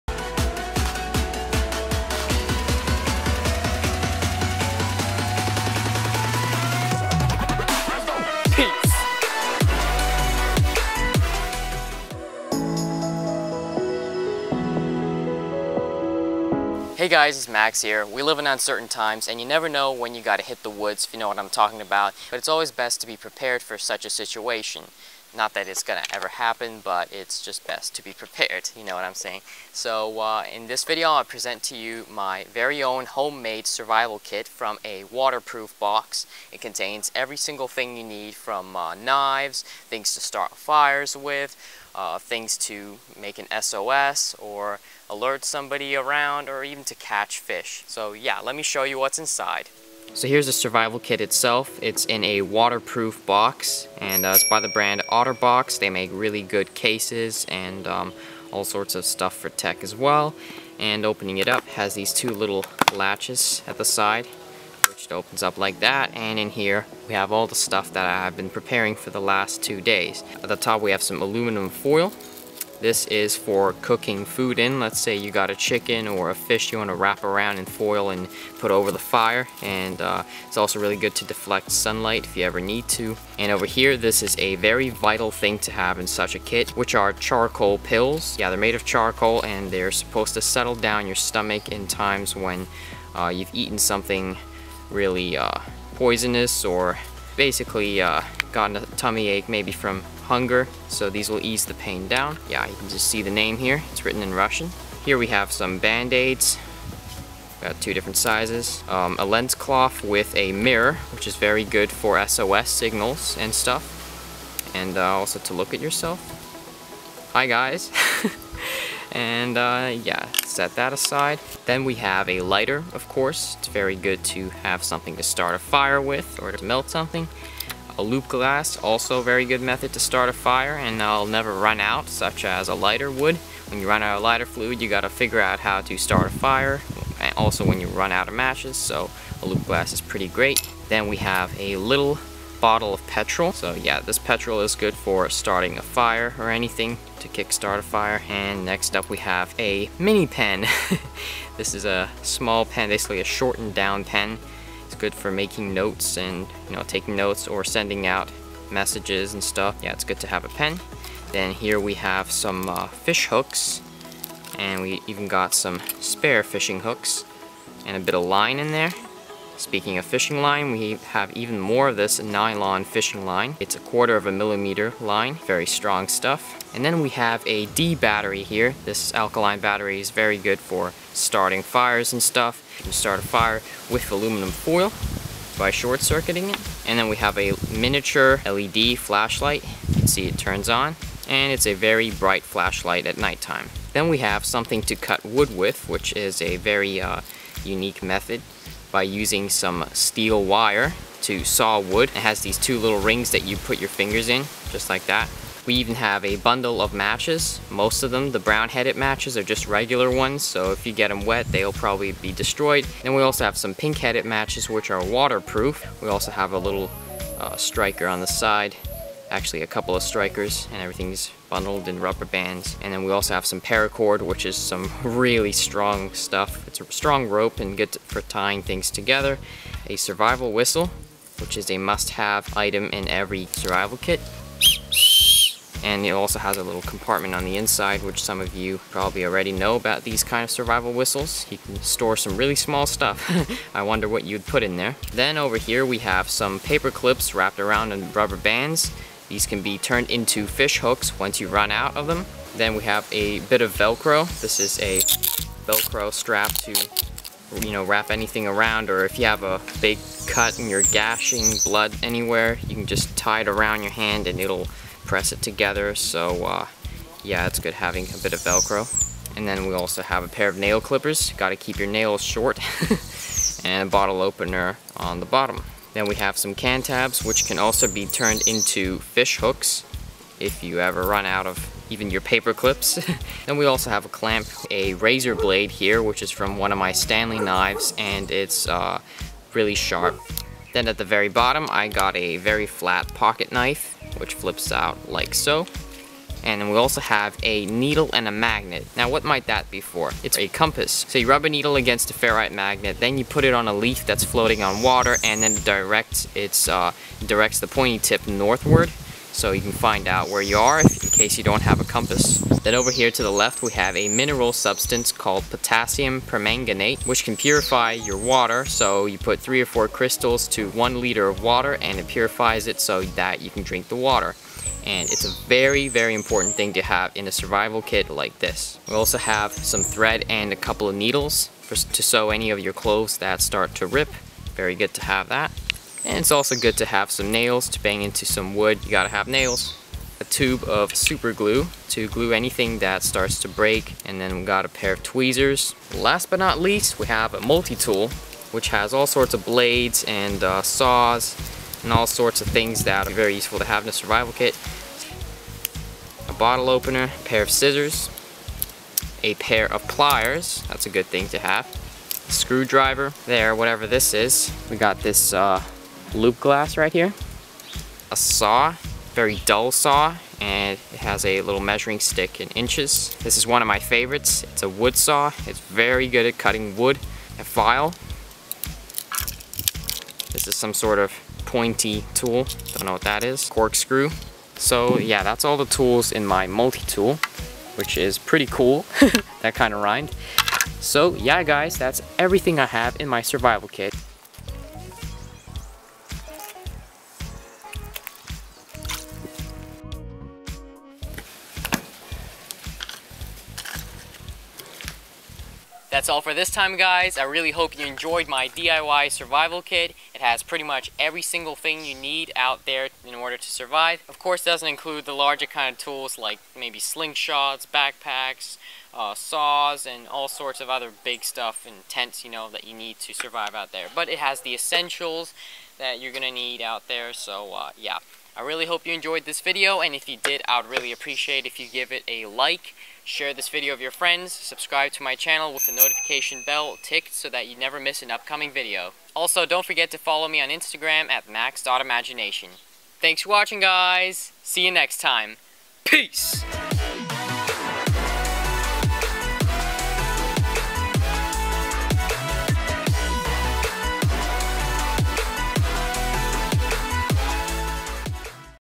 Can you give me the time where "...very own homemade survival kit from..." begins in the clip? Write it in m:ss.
0:32.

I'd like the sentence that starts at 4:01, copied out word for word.
You can store some really small stuff.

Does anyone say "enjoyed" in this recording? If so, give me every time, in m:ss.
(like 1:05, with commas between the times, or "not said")
6:47, 7:08.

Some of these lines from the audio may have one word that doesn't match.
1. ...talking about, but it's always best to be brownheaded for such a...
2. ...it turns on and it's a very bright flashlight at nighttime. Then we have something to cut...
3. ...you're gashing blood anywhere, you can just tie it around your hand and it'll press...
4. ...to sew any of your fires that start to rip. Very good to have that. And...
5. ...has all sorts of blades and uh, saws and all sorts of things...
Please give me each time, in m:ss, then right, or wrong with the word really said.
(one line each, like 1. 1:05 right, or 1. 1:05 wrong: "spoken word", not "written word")
1. 0:21 wrong: "prepared", not "brownheaded"
2. 3:10 right
3. 4:20 right
4. 5:31 wrong: "clothes", not "fires"
5. 5:48 right.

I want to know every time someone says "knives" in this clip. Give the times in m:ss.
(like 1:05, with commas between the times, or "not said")
0:38, 4:47.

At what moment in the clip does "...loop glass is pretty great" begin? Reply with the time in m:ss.
2:19.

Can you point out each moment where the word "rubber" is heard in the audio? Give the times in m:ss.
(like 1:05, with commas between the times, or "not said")
3:41, 4:08.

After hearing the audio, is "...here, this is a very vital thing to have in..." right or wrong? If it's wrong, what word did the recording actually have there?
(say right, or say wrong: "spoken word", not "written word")
right.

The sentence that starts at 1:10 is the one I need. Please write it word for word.
At the top we have some aluminum foil.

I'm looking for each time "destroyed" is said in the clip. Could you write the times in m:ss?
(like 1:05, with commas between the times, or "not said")
3:32.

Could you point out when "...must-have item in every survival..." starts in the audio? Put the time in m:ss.
3:51.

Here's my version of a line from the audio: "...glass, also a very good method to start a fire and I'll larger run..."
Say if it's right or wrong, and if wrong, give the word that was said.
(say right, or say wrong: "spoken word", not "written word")
wrong: "never", not "larger".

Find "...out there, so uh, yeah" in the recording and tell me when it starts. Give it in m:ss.
7:06.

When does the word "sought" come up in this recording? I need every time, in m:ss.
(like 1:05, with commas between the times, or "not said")
not said.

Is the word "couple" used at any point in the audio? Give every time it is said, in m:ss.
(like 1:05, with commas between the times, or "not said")
3:39, 5:30.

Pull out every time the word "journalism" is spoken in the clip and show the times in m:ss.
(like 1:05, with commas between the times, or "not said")
not said.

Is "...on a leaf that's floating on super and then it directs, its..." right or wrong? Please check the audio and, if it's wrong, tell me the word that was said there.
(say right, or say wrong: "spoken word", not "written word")
wrong: "water", not "super".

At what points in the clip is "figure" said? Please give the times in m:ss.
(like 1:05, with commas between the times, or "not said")
2:15.